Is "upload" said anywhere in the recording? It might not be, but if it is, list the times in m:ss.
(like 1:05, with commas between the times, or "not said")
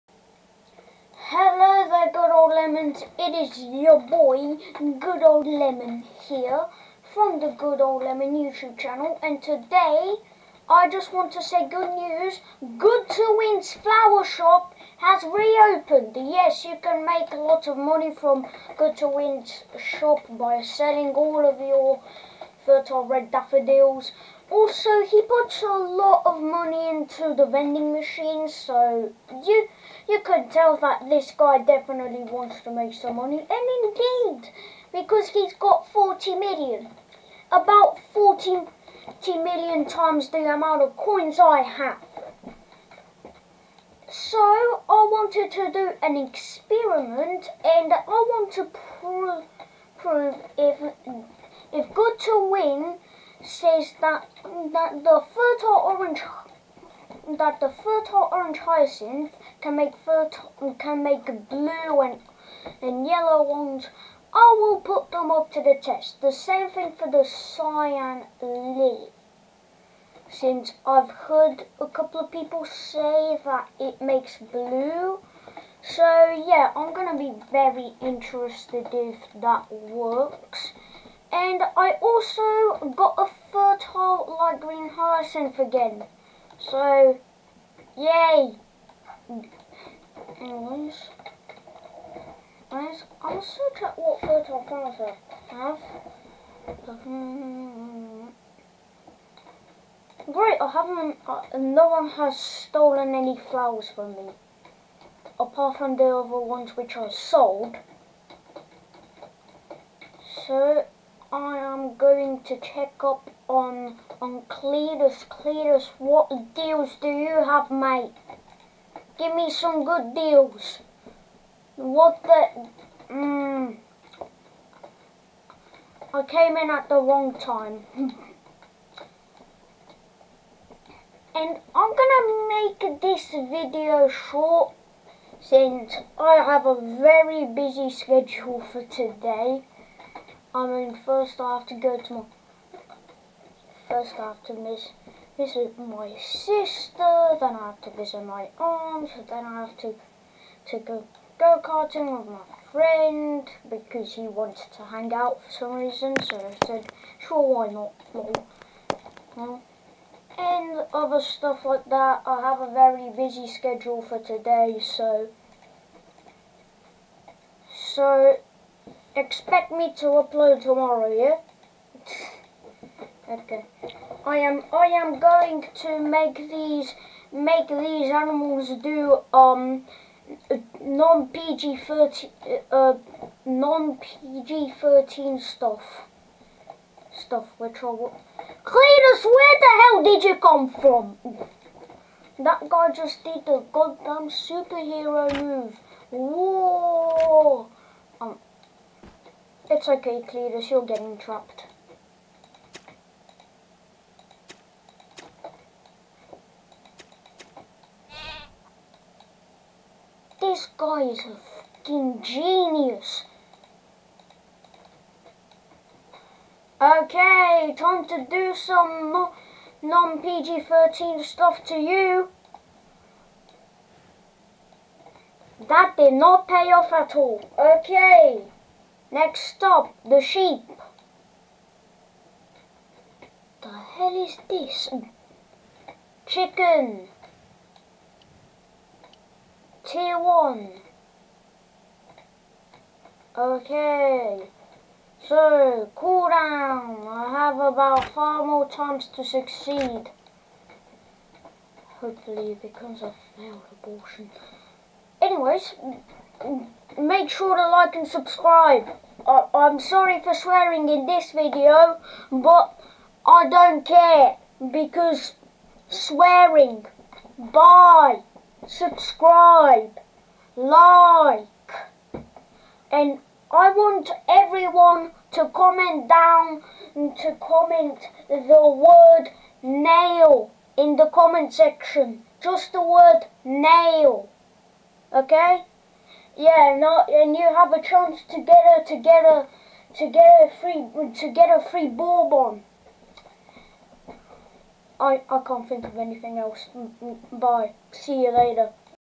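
2:50.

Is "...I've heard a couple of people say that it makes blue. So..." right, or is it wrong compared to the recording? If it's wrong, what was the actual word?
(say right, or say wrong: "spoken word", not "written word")
right.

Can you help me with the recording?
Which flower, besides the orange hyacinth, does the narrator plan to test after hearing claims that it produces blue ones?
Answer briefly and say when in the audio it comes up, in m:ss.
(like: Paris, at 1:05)
cyan lily, at 1:07.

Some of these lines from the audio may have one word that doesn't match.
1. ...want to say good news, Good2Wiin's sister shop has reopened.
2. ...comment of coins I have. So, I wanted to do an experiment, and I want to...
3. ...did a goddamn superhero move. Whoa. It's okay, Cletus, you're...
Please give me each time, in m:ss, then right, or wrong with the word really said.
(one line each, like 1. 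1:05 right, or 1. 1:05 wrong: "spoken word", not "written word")
1. 0:11 wrong: "flower", not "sister"
2. 0:40 wrong: "amount", not "comment"
3. 3:13 right.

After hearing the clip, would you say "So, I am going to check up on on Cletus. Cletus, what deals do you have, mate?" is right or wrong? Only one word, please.
right.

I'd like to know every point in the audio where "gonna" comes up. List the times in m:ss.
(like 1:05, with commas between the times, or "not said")
1:16, 2:12.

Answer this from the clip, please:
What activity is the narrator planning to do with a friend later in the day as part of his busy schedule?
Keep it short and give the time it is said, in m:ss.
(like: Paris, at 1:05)
go-karting, at 2:31.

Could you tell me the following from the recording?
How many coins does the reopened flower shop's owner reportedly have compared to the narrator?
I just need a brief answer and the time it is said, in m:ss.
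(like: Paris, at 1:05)
40 million, at 0:37.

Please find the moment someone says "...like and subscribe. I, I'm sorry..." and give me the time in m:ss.
4:17.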